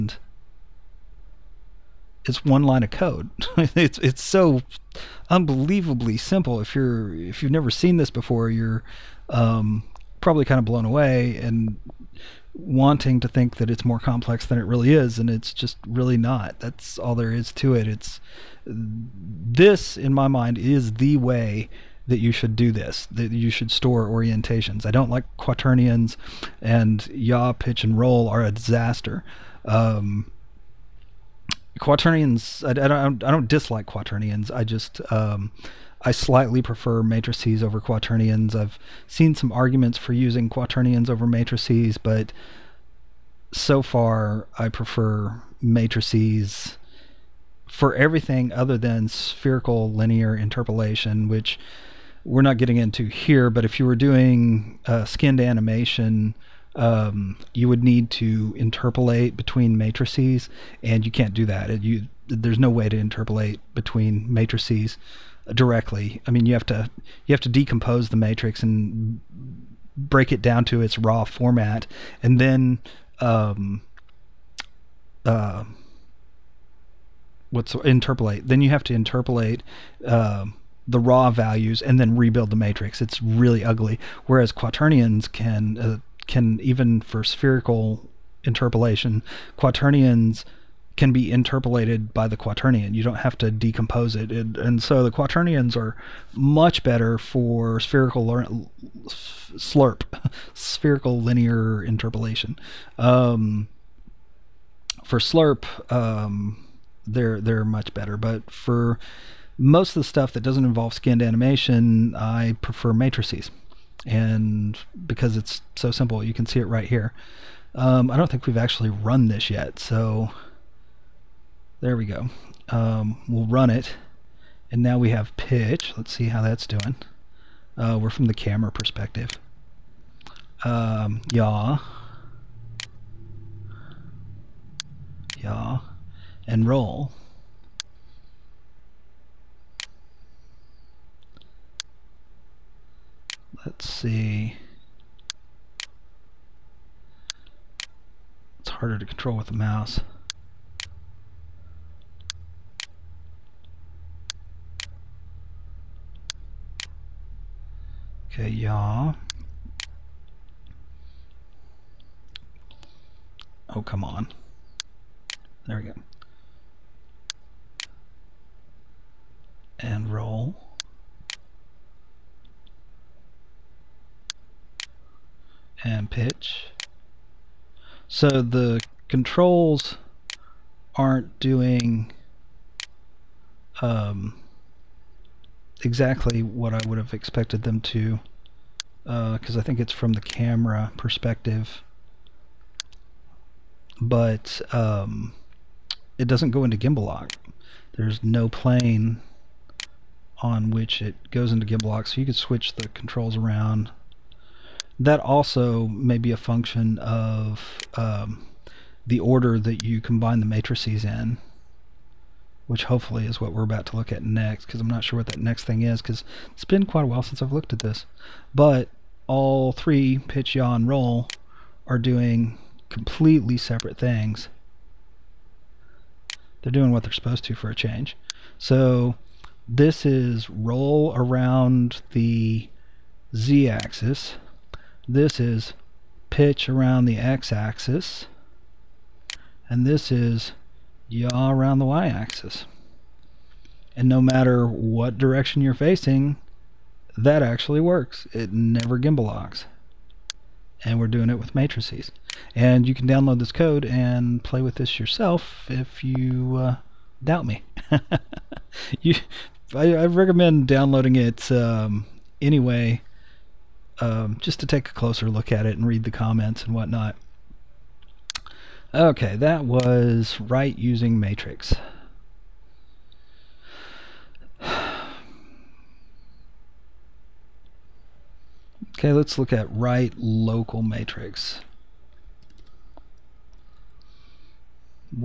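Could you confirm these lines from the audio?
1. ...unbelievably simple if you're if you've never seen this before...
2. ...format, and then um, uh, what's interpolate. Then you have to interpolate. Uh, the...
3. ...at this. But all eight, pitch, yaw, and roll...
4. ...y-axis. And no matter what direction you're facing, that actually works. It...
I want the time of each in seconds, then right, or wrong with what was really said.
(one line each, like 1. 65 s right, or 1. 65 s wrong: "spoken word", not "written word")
1. 5 s right
2. 71 s right
3. 217 s wrong: "three", not "eight"
4. 241 s right.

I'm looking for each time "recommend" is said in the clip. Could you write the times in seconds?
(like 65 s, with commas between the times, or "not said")
260 s.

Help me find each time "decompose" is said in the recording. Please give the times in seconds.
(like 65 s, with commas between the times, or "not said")
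67 s, 93 s.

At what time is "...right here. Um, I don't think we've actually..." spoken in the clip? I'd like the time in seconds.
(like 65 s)
116 s.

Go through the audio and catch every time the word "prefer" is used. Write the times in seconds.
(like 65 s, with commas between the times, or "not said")
36 s, 44 s, 112 s.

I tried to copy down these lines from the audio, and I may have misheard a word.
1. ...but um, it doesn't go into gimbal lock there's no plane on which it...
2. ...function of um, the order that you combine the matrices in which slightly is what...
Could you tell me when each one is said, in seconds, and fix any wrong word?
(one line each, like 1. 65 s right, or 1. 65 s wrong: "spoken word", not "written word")
1. 193 s right
2. 206 s wrong: "hopefully", not "slightly".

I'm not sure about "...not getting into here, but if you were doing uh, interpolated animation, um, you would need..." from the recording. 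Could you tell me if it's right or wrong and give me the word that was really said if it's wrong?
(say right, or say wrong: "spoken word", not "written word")
wrong: "skinned", not "interpolated".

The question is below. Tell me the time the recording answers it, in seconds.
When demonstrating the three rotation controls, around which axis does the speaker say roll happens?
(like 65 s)
233 s.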